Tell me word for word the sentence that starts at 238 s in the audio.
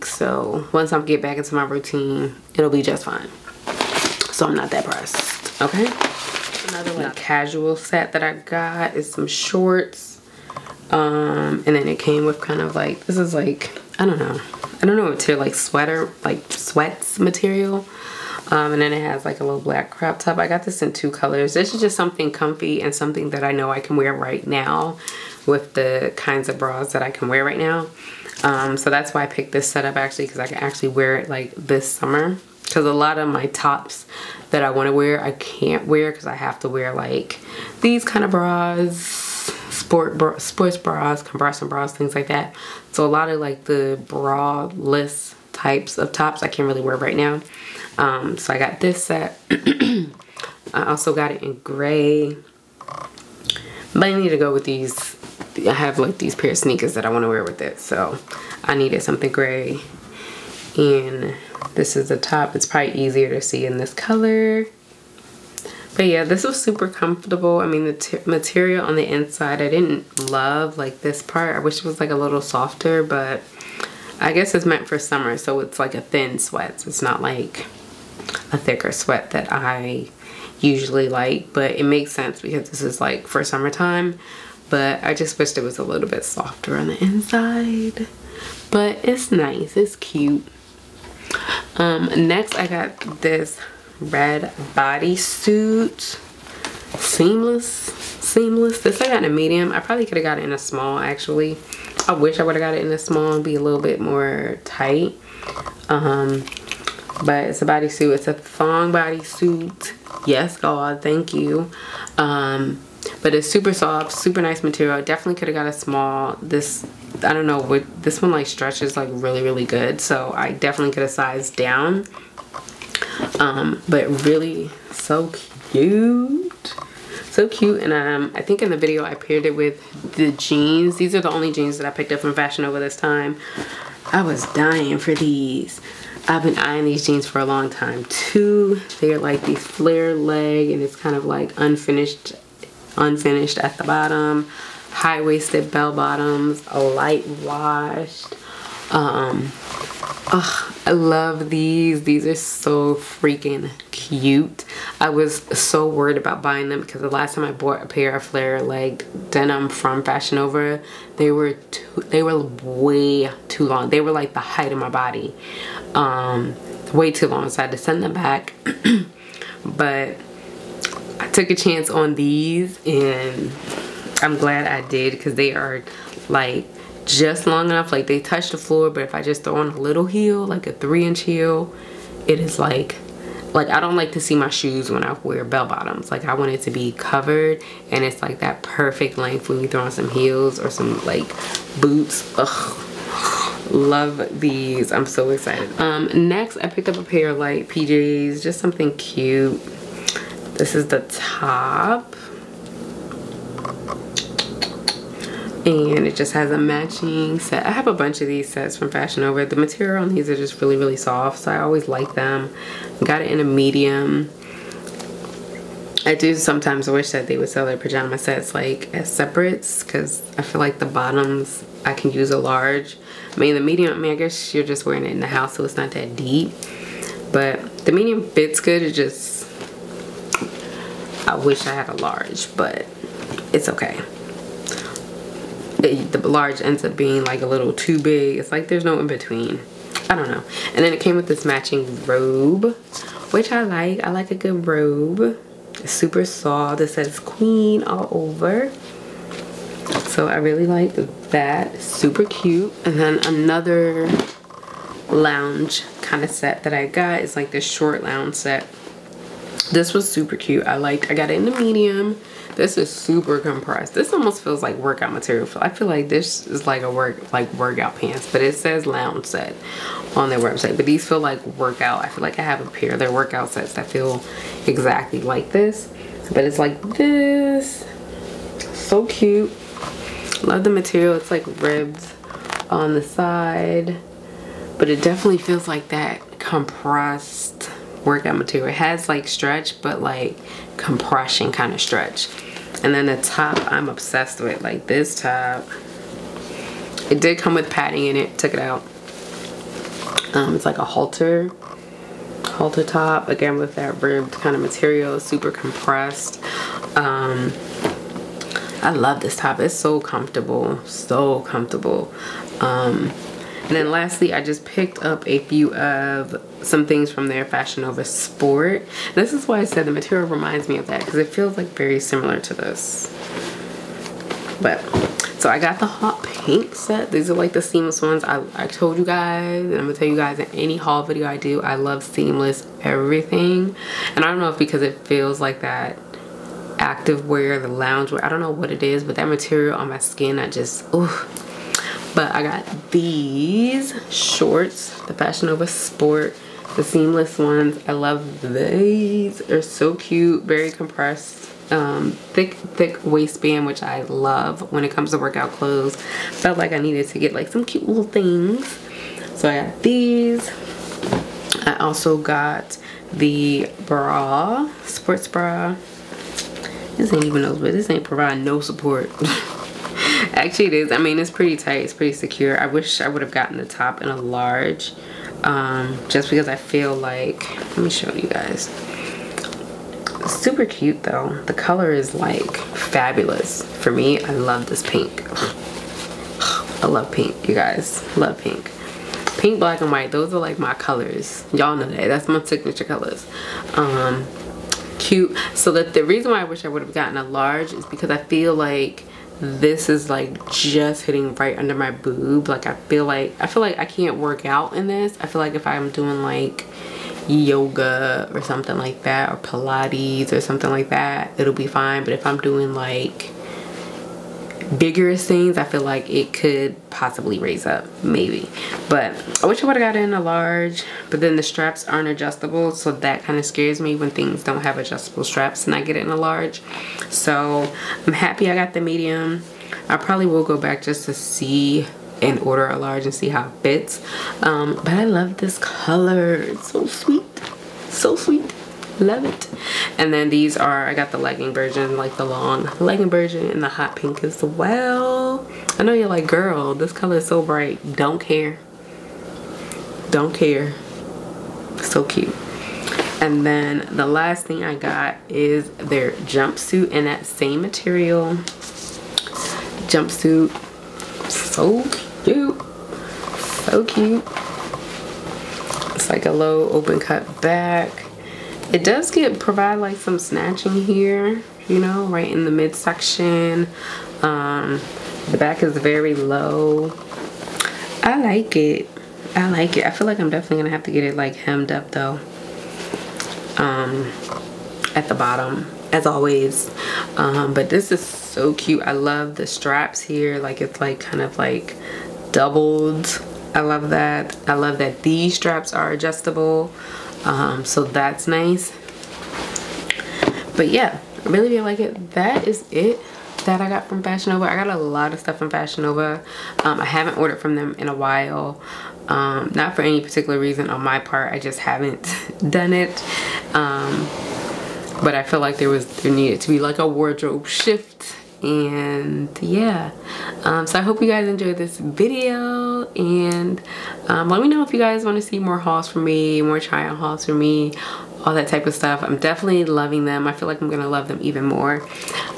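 It's like there's no in between.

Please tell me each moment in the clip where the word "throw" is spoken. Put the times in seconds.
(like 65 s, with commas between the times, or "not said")
179 s, 189 s.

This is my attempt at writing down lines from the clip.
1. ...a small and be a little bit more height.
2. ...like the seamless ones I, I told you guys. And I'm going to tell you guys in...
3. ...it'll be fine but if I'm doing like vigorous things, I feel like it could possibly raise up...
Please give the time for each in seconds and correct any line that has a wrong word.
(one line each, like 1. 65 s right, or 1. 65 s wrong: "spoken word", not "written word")
1. 102 s wrong: "tight", not "height"
2. 327 s right
3. 411 s right.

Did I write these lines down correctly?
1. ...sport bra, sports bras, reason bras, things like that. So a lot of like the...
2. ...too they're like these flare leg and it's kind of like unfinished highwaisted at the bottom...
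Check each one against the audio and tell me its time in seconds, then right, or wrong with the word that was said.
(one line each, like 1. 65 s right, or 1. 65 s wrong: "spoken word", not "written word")
1. 39 s wrong: "compression", not "reason"
2. 138 s wrong: "unfinished", not "highwaisted".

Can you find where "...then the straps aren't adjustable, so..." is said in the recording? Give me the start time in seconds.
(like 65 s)
421 s.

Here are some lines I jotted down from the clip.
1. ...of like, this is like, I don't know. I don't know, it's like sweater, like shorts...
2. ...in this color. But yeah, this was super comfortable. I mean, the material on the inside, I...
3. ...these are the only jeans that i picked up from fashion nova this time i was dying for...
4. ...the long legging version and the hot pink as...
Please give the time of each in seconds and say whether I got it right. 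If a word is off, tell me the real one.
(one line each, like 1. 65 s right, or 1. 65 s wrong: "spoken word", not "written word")
1. 12 s wrong: "sweats", not "shorts"
2. 63 s right
3. 130 s right
4. 442 s right.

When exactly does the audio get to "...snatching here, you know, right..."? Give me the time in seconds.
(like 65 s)
470 s.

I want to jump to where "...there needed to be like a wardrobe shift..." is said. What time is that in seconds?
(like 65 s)
516 s.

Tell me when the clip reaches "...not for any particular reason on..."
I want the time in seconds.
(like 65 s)
509 s.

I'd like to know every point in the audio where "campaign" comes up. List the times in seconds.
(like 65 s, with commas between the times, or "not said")
not said.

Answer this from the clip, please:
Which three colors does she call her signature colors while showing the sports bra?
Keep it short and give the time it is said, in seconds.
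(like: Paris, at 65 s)
Pink, black and white, at 389 s.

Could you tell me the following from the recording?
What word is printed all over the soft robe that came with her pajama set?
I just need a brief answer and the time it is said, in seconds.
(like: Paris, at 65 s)
Queen, at 247 s.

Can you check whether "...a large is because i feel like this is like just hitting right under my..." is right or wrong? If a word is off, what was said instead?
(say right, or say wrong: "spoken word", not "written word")
right.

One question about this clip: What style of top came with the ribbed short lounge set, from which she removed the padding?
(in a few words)
Halter top.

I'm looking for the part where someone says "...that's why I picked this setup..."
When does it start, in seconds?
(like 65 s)
28 s.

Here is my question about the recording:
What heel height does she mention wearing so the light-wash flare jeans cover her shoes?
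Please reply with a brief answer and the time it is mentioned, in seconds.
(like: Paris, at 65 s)
3 inch, at 180 s.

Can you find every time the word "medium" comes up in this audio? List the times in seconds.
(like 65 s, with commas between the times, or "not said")
99 s, 213 s, 223 s, 227 s, 261 s, 428 s.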